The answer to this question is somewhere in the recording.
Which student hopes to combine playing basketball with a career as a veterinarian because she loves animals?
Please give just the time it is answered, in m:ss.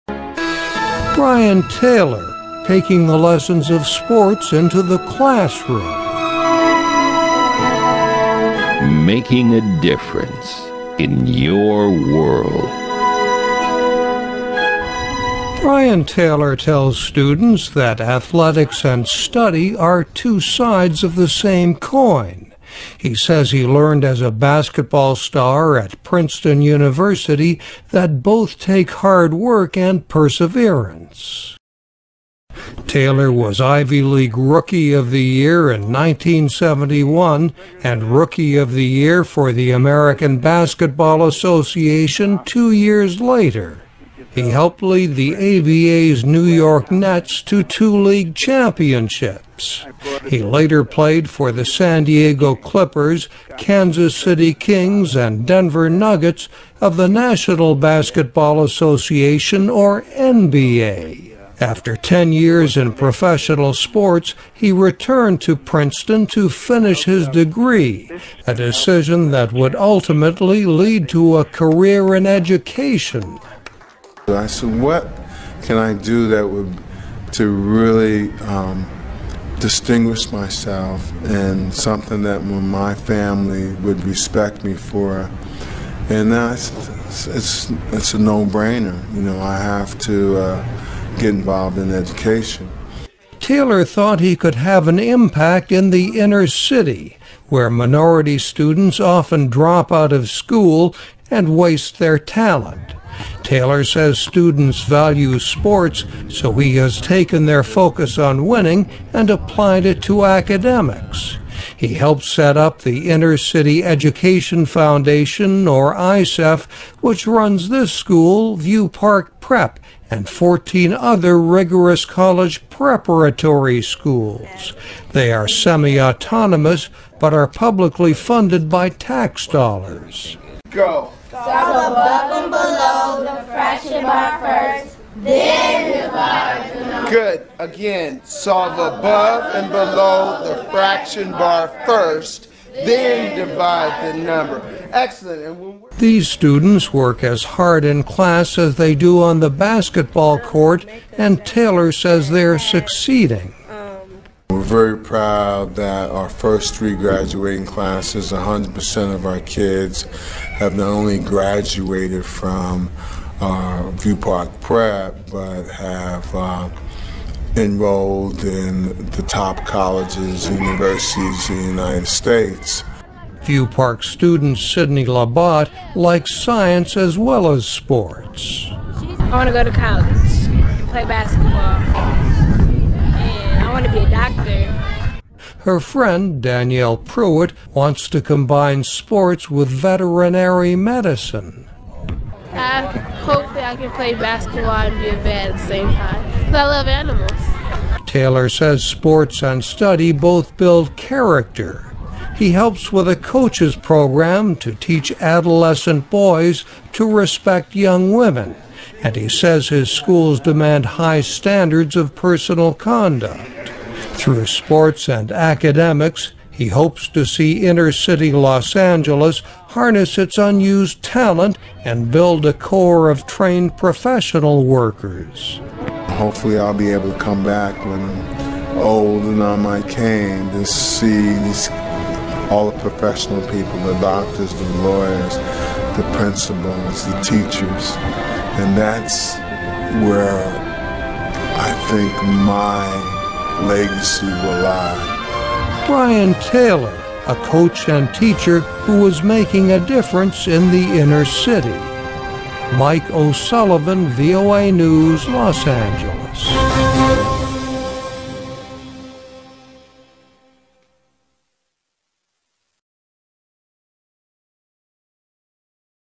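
3:06.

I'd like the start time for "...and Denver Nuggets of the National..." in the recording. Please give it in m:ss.
0:55.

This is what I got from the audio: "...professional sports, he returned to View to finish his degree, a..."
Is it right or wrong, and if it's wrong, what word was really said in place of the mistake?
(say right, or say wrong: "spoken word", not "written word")
wrong: "Princeton", not "View".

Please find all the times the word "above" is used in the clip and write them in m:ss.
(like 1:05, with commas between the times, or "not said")
2:11, 2:18.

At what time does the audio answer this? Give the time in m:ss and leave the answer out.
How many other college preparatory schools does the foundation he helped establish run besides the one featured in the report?
2:00.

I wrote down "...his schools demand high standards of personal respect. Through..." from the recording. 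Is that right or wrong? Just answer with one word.
wrong.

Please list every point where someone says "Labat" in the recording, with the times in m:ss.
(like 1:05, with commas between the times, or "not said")
2:55.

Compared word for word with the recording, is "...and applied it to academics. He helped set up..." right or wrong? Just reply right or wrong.
right.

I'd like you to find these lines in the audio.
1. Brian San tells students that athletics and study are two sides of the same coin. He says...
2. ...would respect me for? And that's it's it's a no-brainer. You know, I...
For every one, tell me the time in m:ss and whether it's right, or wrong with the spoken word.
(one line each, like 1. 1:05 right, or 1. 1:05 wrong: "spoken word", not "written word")
1. 0:15 wrong: "Taylor", not "San"
2. 1:23 right.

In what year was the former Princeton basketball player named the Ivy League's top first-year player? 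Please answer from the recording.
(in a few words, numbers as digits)
1971.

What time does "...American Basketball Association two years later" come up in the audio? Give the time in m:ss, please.
0:39.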